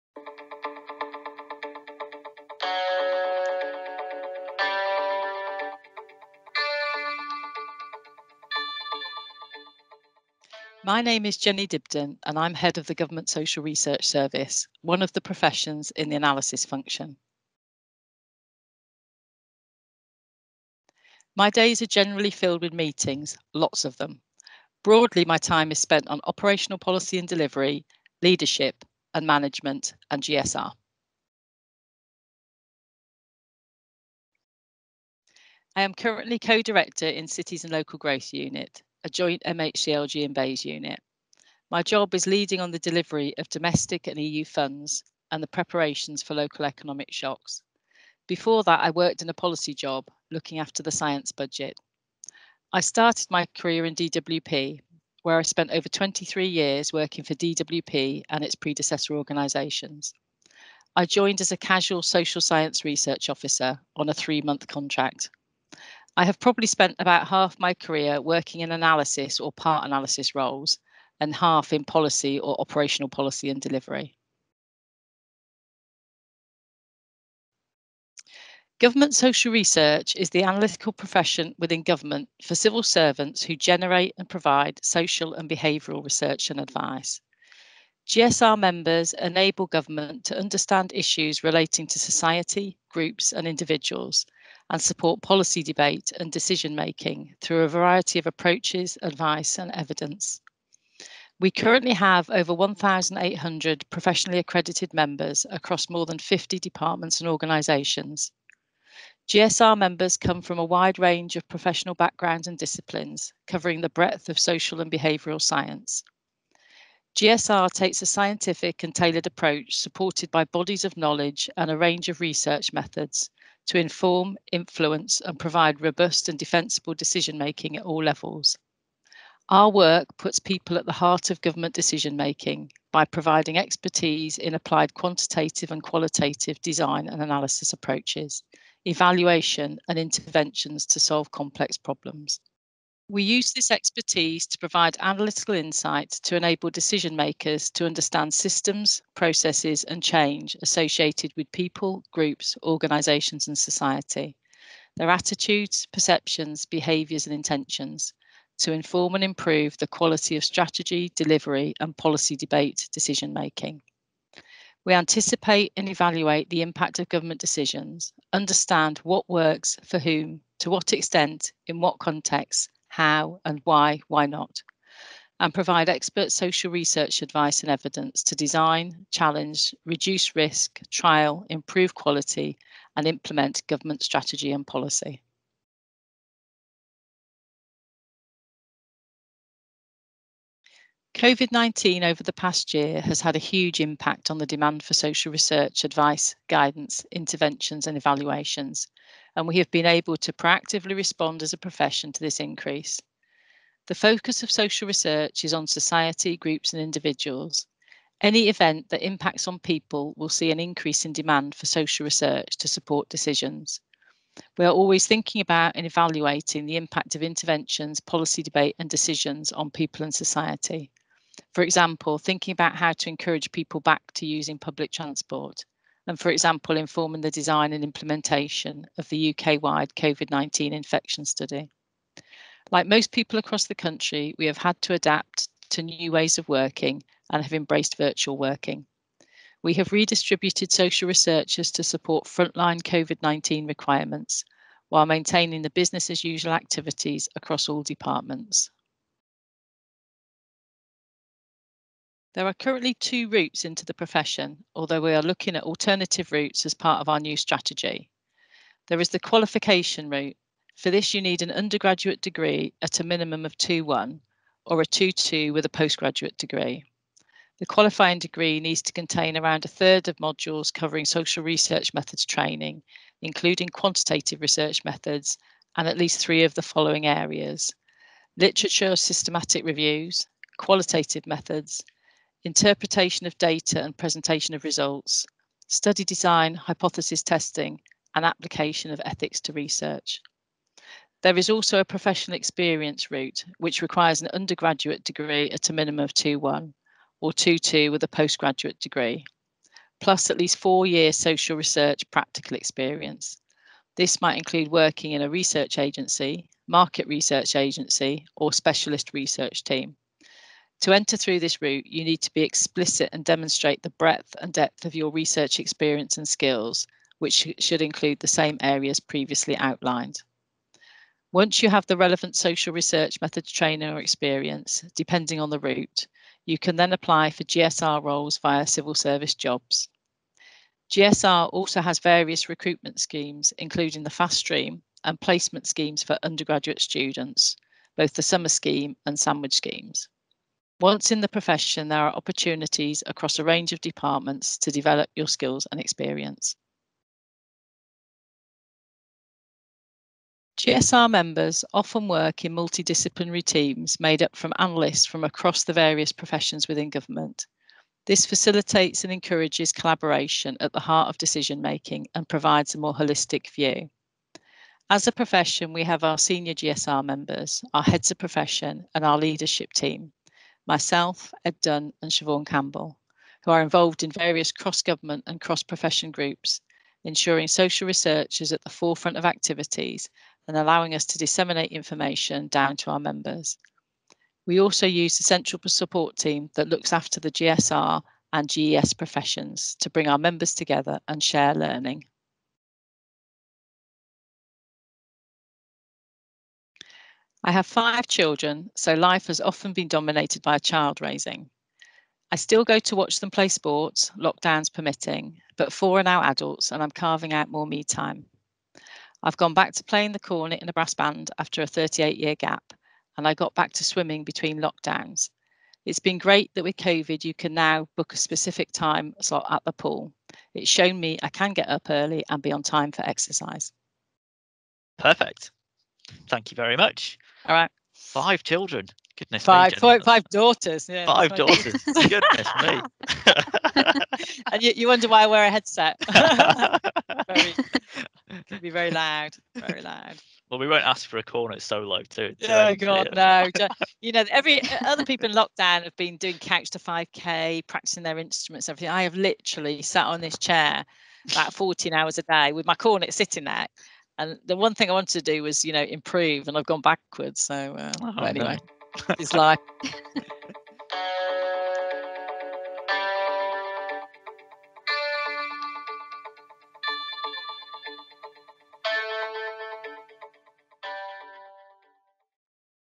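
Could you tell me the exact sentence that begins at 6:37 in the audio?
I have five children, so life has often been dominated by child raising.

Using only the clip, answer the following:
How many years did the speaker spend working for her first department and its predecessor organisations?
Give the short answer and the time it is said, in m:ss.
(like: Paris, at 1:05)
23, at 0:55.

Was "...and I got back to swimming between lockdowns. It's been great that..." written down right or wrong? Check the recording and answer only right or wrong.
right.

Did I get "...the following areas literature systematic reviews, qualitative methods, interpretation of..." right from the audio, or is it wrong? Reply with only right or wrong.
right.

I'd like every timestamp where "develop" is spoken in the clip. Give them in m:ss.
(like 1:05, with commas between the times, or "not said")
5:44.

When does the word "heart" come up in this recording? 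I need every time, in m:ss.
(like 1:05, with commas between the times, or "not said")
2:11, 6:00.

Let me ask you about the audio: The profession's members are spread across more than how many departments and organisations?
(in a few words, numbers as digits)
50.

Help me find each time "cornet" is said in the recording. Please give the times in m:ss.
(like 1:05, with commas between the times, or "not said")
6:50, 7:21, 7:32.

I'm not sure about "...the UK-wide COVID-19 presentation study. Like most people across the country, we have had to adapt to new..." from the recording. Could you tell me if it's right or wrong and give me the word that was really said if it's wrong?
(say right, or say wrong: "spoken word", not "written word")
wrong: "infection", not "presentation".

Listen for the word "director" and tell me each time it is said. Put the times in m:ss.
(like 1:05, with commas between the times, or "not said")
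0:36.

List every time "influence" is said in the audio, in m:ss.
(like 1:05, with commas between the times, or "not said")
2:04.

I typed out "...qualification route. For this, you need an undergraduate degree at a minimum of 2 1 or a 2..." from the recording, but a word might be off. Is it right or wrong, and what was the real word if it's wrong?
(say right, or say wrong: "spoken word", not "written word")
right.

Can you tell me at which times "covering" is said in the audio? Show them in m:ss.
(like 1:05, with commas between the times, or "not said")
1:53, 4:30.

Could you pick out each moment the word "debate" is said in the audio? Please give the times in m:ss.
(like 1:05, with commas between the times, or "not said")
1:35, 2:42, 3:38.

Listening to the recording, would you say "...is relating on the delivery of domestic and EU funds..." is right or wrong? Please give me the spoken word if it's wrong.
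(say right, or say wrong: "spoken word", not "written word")
wrong: "leading", not "relating".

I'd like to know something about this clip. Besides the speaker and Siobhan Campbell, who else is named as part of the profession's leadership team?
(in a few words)
Ed Dunn.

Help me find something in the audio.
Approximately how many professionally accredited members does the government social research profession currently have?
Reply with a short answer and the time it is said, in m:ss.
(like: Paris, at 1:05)
1,800, at 1:42.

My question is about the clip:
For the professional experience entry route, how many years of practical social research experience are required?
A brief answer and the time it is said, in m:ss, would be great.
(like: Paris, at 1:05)
4, at 5:00.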